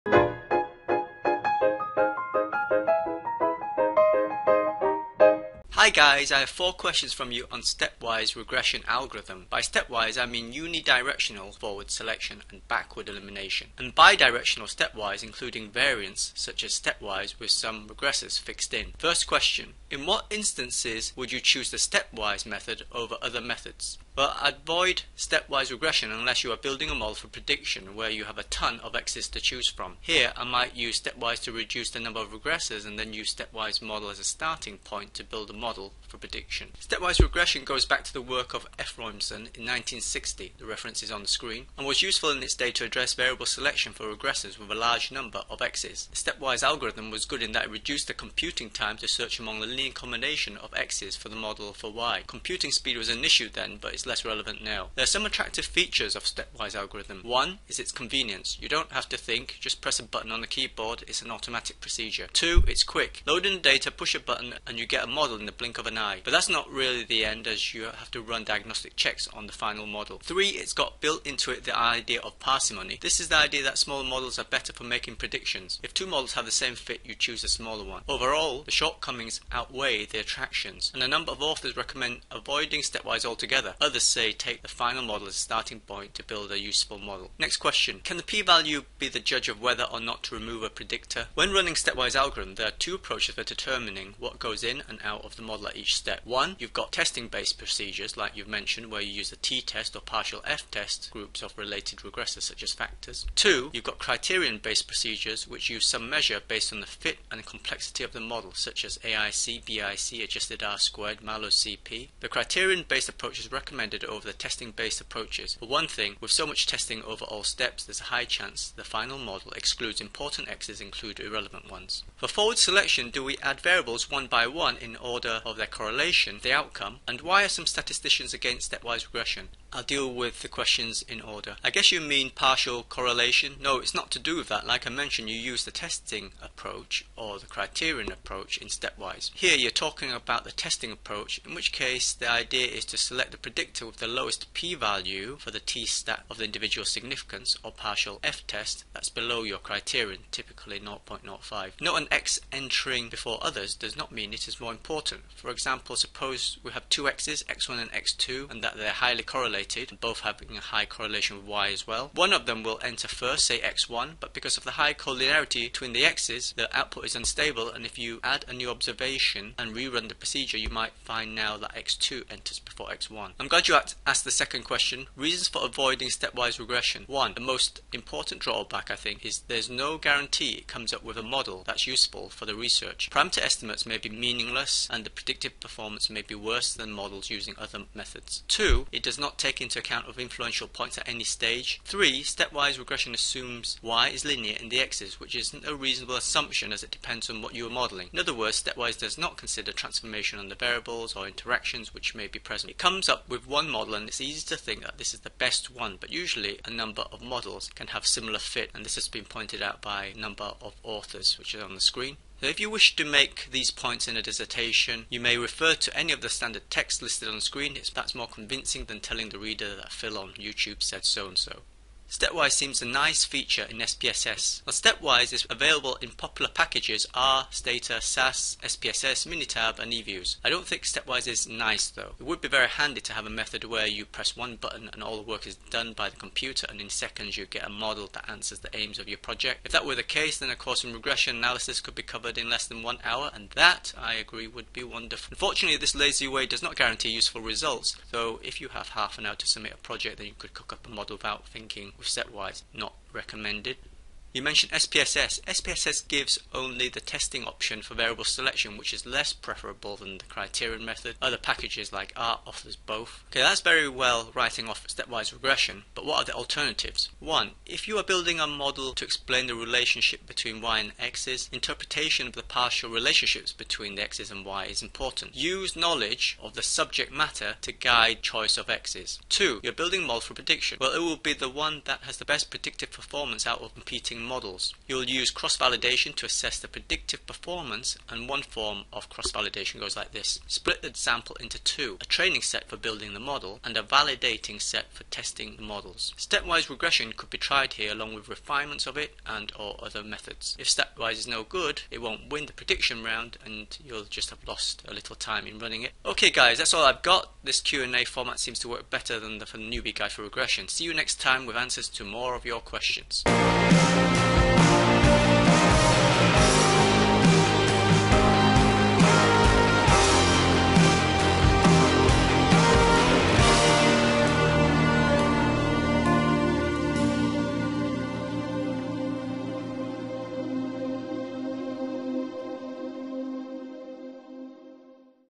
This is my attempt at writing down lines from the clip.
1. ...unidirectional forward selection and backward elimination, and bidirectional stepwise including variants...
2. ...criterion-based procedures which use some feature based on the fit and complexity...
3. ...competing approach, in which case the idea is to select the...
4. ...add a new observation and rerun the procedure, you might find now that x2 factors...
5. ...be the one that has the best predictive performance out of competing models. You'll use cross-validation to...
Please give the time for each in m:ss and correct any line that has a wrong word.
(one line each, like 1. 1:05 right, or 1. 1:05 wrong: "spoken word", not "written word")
1. 0:10 right
2. 1:43 wrong: "measure", not "feature"
3. 2:20 wrong: "testing", not "competing"
4. 2:48 wrong: "enters", not "factors"
5. 4:41 right.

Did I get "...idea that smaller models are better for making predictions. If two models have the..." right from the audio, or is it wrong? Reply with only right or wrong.
right.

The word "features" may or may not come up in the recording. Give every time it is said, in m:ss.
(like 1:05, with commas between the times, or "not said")
0:55, 3:43.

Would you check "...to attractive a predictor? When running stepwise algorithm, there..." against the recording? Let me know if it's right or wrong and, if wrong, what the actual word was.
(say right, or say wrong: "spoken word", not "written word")
wrong: "remove", not "attractive".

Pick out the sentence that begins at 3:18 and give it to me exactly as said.
In other words, stepwise does not consider transformation on the variables or interactions which may be present.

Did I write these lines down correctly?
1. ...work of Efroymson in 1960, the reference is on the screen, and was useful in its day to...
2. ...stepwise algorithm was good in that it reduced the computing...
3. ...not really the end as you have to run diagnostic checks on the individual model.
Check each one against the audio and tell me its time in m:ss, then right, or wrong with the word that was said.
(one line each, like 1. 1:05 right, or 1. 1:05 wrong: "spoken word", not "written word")
1. 0:38 right
2. 0:46 right
3. 1:06 wrong: "final", not "individual".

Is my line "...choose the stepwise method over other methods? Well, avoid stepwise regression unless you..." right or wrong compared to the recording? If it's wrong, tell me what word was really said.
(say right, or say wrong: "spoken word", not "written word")
right.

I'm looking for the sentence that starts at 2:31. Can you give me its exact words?
Note an x entering before others does not mean it is more important.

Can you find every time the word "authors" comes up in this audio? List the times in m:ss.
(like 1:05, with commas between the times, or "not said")
1:21, 3:30.